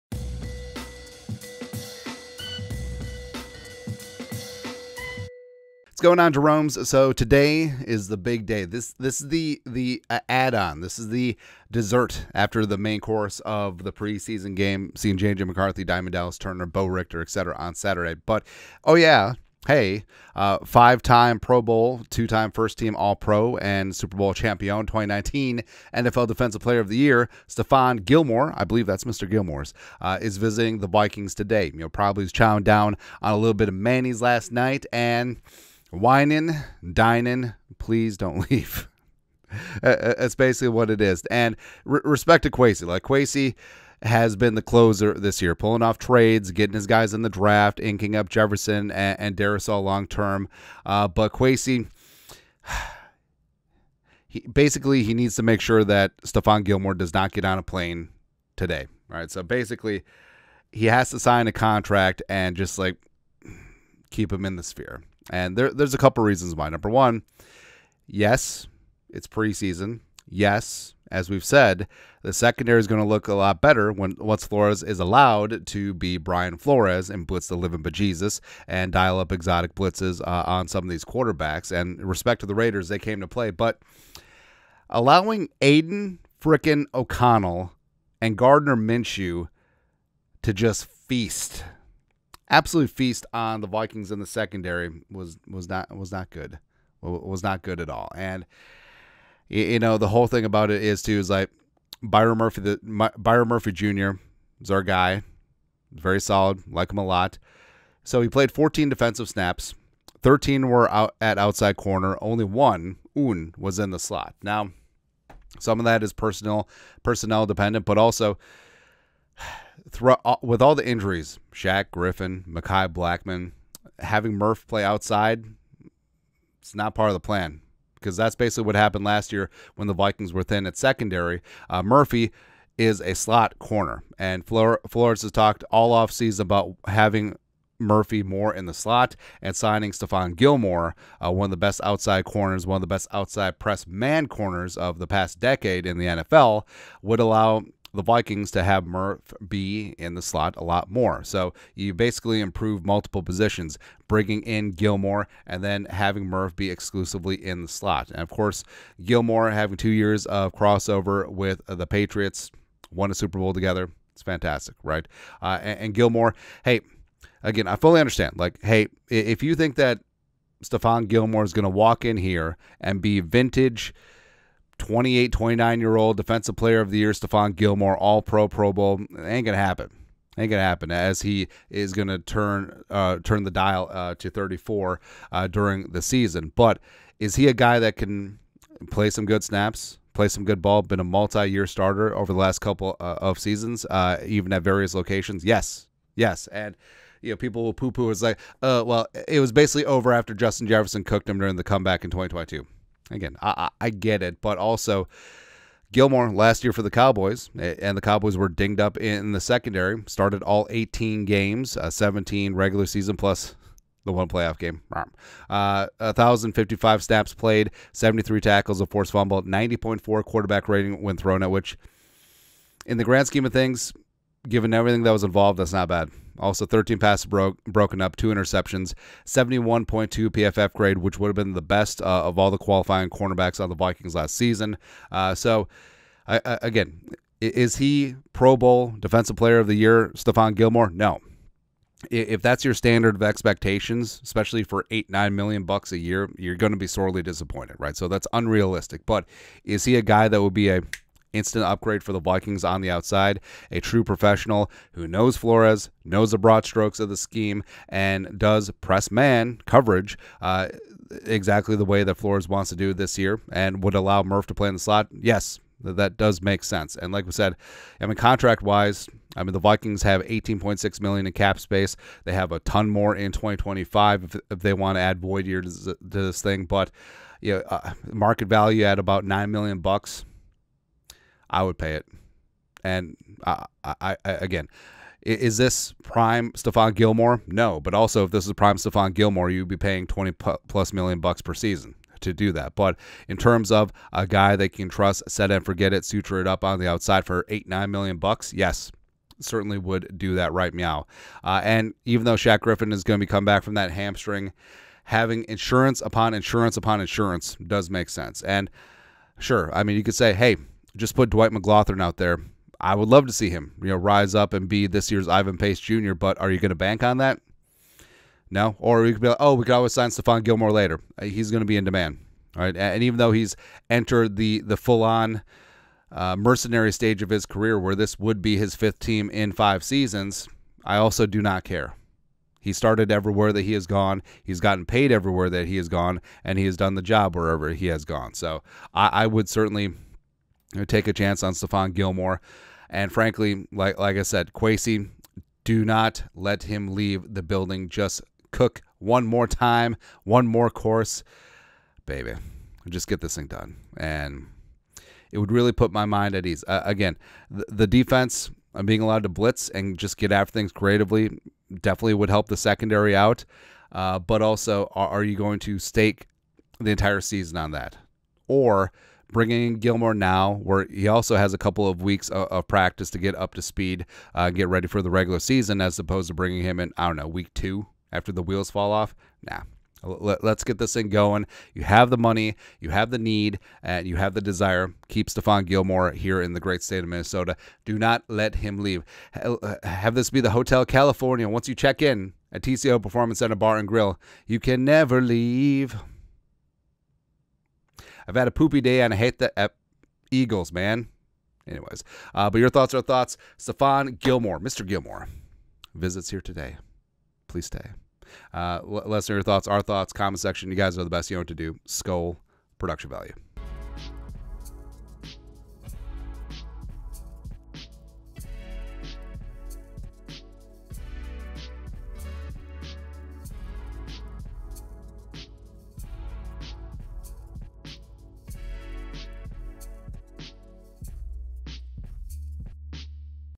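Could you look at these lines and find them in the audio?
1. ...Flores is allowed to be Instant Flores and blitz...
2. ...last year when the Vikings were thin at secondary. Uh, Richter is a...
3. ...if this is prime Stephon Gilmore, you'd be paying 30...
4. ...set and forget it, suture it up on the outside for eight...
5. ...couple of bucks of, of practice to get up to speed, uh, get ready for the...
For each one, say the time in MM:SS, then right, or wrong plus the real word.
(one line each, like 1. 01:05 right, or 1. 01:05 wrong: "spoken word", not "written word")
1. 01:14 wrong: "Brian", not "Instant"
2. 02:09 wrong: "Murphy", not "Richter"
3. 04:48 wrong: "20", not "30"
4. 04:55 right
5. 06:11 wrong: "weeks", not "bucks".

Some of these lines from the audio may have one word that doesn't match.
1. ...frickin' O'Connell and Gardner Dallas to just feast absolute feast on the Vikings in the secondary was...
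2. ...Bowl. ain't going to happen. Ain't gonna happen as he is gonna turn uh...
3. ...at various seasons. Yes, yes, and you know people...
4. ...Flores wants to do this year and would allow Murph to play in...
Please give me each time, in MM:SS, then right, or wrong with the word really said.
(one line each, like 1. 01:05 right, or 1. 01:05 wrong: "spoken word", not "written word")
1. 01:26 wrong: "Minshew", not "Dallas"
2. 02:58 right
3. 03:14 wrong: "locations", not "seasons"
4. 04:22 right.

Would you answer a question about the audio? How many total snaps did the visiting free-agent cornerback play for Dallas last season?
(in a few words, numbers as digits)
1,055.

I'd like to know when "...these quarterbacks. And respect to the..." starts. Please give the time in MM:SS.
01:20.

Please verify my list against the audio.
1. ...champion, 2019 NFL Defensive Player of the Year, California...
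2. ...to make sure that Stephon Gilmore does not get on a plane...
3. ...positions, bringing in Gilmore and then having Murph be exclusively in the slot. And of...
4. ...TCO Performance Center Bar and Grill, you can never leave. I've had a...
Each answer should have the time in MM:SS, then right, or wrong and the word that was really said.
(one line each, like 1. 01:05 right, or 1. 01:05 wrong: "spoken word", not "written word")
1. 00:24 wrong: "Stephon", not "California"
2. 00:55 right
3. 02:33 right
4. 06:32 right.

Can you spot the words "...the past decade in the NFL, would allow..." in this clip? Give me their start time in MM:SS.
02:24.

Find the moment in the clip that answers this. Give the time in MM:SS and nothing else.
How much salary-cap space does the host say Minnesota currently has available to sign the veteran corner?
04:30.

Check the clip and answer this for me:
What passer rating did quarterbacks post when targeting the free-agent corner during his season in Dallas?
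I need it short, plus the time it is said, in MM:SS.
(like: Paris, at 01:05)
90.4, at 03:39.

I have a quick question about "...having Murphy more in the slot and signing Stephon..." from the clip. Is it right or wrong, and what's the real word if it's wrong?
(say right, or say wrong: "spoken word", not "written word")
right.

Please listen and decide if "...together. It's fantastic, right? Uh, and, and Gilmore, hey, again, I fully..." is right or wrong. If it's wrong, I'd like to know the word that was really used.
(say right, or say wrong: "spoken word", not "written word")
right.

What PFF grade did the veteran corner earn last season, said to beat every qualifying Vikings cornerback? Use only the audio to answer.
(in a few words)
71.2.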